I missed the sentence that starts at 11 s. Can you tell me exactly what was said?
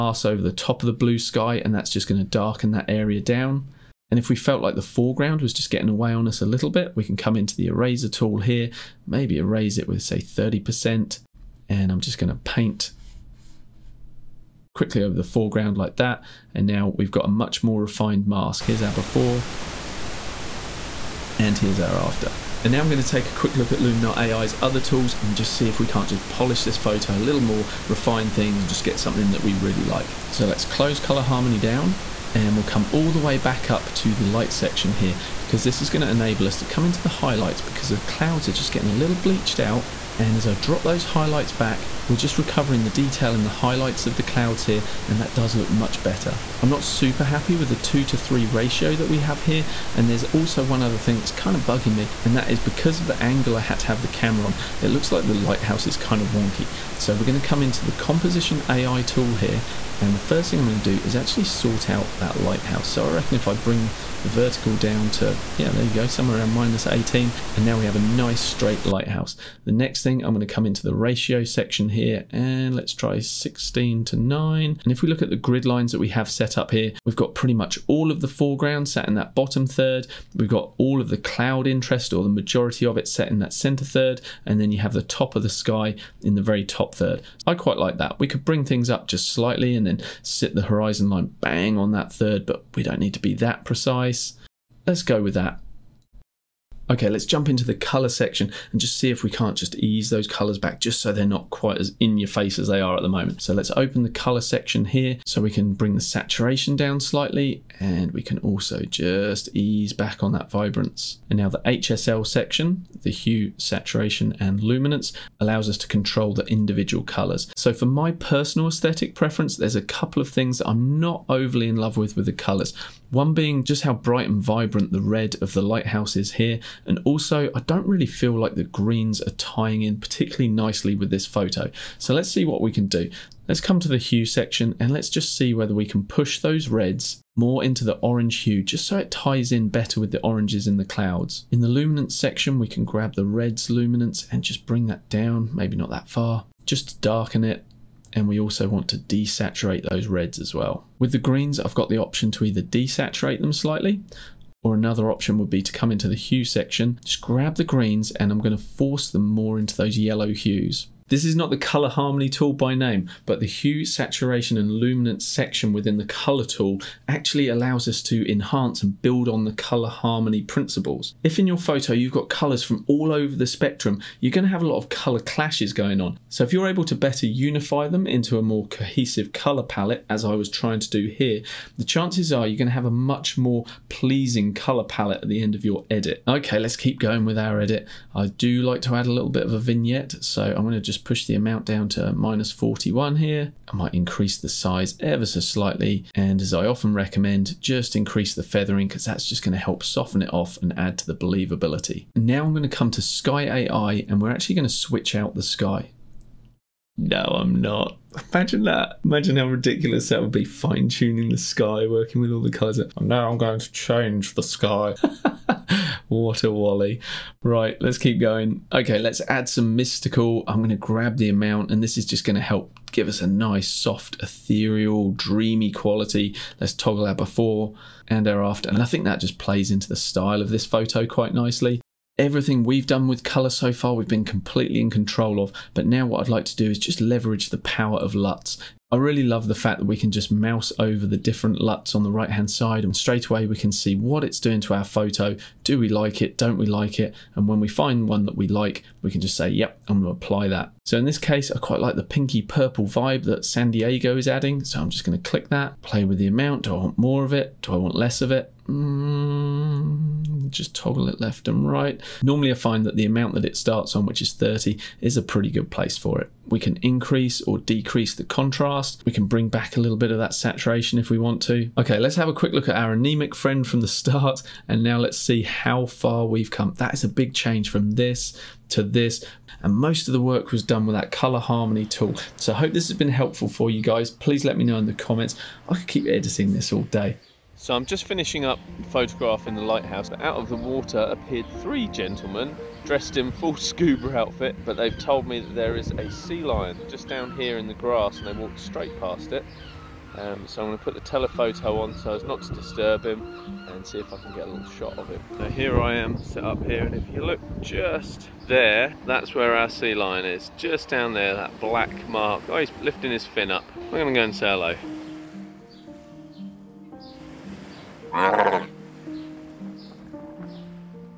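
And I'm just going to paint quickly over the foreground like that.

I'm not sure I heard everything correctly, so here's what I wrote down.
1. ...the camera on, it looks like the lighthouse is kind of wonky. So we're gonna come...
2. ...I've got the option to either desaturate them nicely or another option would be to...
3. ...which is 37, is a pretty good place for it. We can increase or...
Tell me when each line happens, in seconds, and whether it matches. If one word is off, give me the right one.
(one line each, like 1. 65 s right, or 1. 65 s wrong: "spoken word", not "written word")
1. 54 s right
2. 151 s wrong: "slightly", not "nicely"
3. 264 s wrong: "30", not "37".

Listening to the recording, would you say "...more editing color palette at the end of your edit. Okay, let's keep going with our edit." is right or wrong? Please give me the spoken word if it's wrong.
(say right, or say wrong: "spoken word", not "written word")
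wrong: "pleasing", not "editing".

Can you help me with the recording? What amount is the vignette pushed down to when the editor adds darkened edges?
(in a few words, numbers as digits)
-41.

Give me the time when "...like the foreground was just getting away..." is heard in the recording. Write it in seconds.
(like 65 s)
4 s.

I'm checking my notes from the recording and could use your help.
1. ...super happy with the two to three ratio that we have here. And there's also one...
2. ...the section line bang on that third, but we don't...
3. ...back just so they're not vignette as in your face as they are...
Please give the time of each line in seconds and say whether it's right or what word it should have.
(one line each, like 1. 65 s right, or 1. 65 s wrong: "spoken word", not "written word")
1. 46 s right
2. 90 s wrong: "horizon", not "section"
3. 100 s wrong: "quite", not "vignette".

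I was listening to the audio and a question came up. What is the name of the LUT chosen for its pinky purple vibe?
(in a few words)
San Diego.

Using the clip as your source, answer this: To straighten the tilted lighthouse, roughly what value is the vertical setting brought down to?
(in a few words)
-18.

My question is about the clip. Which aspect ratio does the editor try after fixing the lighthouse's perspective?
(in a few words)
16:9.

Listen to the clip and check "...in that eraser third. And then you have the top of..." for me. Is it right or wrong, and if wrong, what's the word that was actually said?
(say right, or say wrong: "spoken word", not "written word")
wrong: "center", not "eraser".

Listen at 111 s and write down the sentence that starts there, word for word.
And now the HSL section, the hue, saturation and luminance allows us to control the individual colors.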